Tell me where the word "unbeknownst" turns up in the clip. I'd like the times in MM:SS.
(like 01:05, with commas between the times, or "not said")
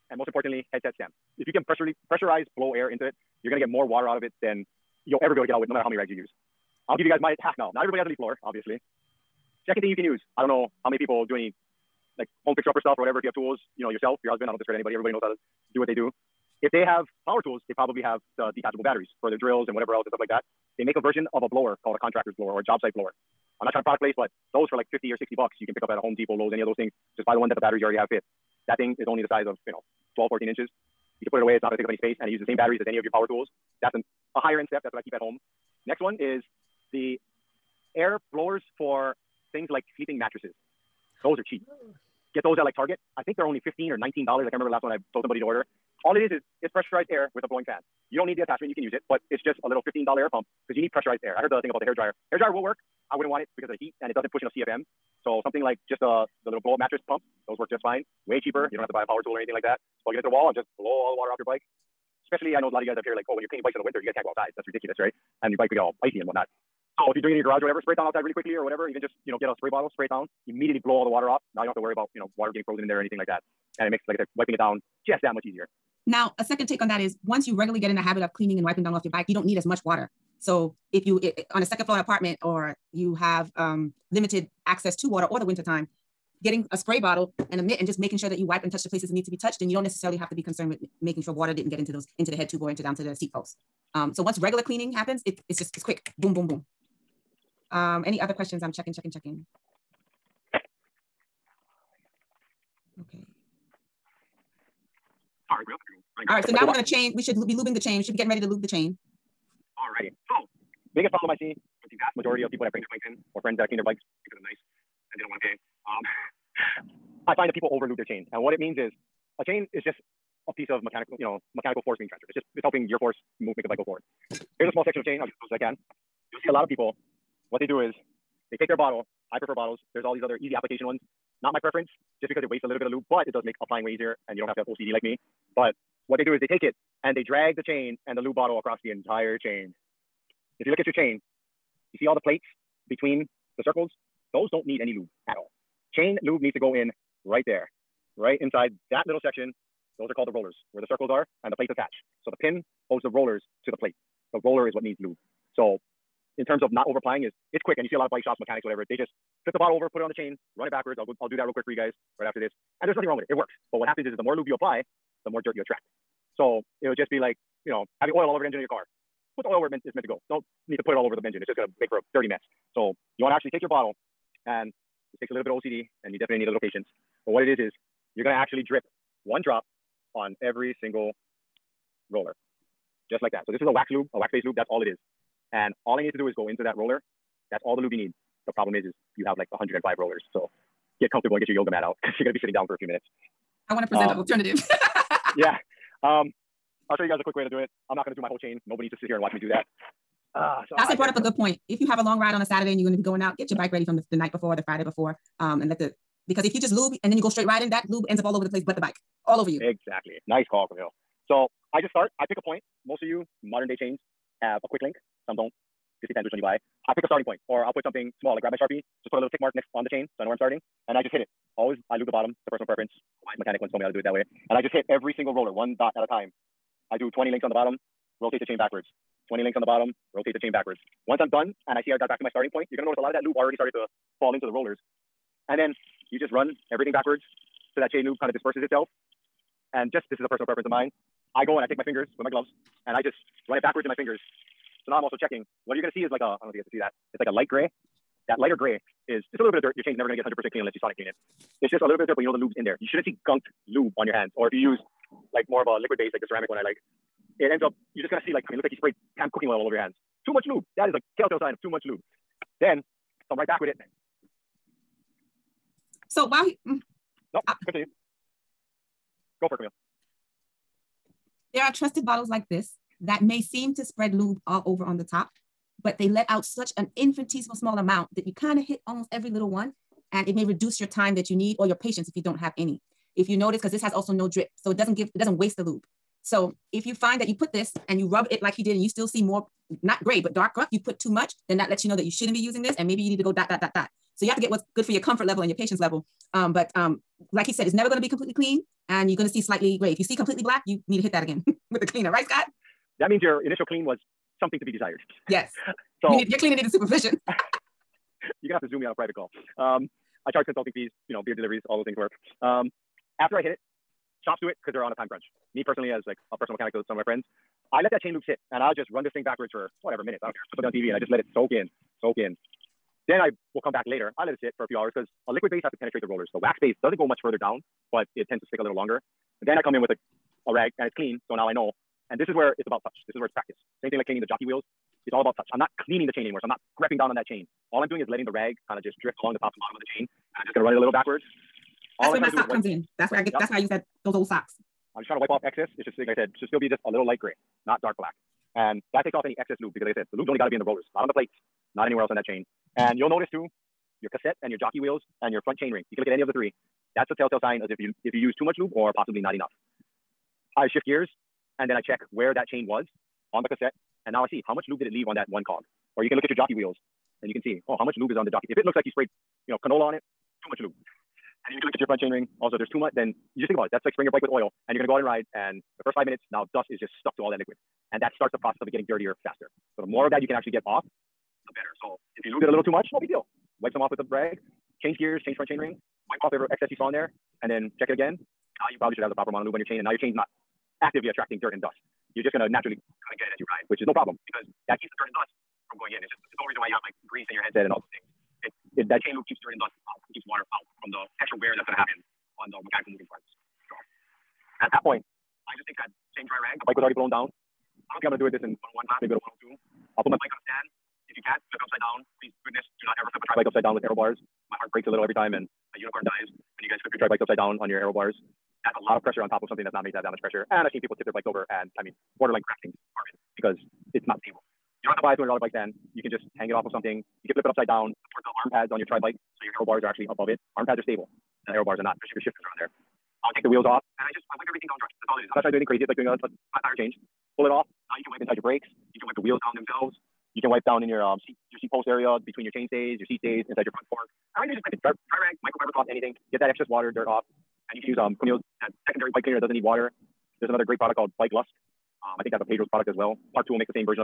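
not said.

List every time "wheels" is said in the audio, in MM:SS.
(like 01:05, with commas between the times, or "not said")
05:34, 05:54, 06:06, 07:13, 07:19.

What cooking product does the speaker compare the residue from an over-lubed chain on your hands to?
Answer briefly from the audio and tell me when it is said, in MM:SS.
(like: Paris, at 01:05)
Pam cooking oil, at 04:19.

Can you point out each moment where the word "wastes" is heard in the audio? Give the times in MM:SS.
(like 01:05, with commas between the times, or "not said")
02:12, 04:45.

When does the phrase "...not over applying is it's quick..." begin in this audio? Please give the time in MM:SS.
02:36.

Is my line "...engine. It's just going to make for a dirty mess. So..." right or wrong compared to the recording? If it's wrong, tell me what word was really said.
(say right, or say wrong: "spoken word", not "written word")
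right.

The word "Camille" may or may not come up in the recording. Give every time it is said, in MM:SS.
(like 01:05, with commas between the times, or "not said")
03:30, 04:29, 07:28.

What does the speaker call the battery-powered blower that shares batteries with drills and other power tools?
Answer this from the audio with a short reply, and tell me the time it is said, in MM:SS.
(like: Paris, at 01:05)
contractor's blower, at 00:21.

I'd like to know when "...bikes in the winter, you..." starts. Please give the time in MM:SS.
01:03.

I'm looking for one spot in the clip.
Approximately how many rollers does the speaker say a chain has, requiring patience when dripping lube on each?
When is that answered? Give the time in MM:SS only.
03:09.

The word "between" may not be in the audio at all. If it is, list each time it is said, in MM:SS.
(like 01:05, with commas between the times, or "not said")
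02:22, 07:22.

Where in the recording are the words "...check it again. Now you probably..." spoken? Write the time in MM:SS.
06:27.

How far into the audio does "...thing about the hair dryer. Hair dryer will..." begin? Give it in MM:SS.
00:51.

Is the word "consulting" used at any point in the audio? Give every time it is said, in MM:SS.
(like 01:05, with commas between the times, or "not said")
05:10.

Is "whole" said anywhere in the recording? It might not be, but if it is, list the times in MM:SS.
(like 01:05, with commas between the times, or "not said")
03:18, 06:36.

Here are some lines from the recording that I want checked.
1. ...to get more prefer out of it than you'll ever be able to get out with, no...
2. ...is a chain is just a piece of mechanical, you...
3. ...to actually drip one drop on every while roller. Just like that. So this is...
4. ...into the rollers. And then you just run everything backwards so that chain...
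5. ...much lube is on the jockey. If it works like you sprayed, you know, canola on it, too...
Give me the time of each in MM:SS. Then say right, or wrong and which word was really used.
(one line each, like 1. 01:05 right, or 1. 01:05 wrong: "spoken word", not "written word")
1. 00:03 wrong: "water", not "prefer"
2. 01:58 right
3. 02:58 wrong: "single", not "while"
4. 03:54 right
5. 06:07 wrong: "looks", not "works".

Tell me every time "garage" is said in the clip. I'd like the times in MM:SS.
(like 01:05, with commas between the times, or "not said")
01:07.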